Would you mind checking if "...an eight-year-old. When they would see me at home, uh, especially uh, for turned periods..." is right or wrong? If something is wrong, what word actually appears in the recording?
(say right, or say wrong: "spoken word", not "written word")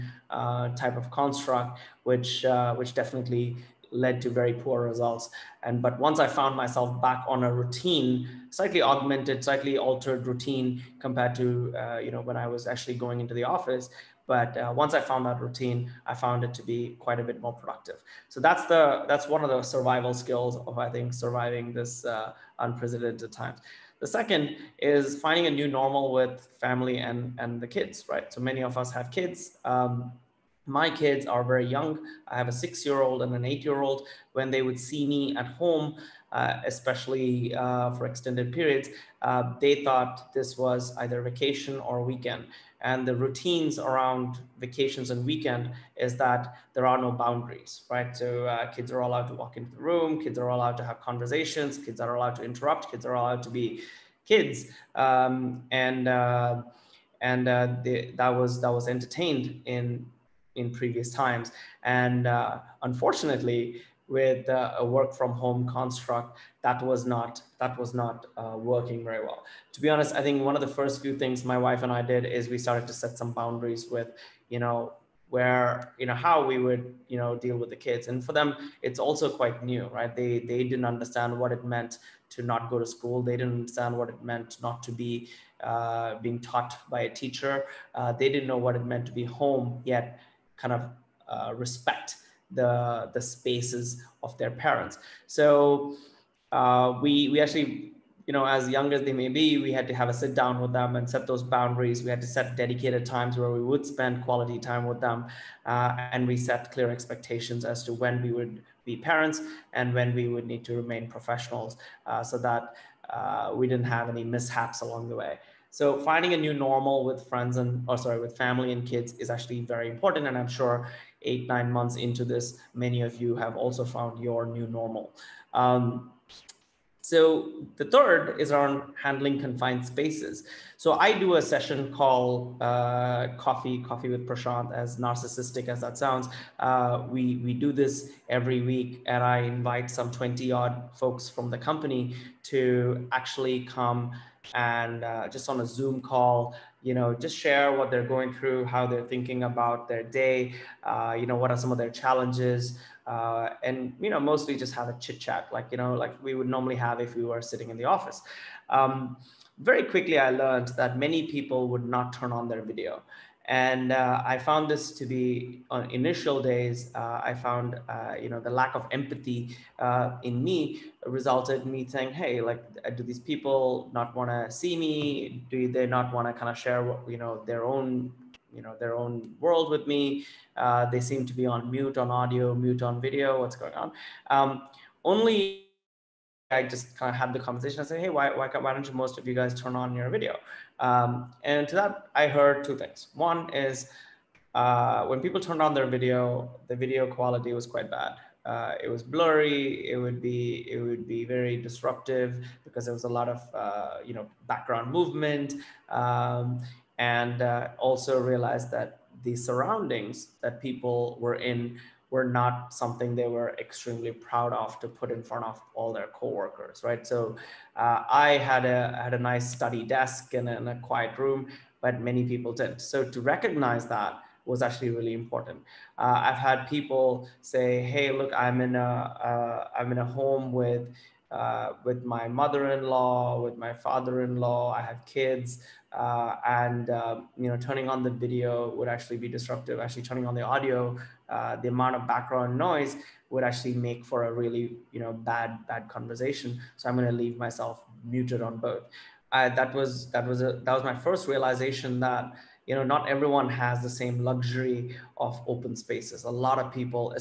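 wrong: "extended", not "turned".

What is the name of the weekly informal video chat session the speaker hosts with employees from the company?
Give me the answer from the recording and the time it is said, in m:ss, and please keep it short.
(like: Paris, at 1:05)
Coffee with Prashanth, at 2:13.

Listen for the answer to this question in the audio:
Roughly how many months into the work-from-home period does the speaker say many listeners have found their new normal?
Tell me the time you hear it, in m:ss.
2:01.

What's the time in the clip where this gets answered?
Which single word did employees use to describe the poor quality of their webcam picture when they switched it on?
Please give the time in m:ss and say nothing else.
3:19.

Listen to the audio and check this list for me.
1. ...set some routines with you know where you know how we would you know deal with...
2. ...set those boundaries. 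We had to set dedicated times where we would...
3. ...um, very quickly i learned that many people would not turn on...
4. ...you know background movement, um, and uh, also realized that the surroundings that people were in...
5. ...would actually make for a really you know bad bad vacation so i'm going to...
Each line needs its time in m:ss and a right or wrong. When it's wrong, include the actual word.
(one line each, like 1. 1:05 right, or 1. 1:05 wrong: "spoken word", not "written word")
1. 1:12 wrong: "boundaries", not "routines"
2. 1:41 right
3. 2:38 right
4. 3:24 right
5. 4:03 wrong: "conversation", not "vacation".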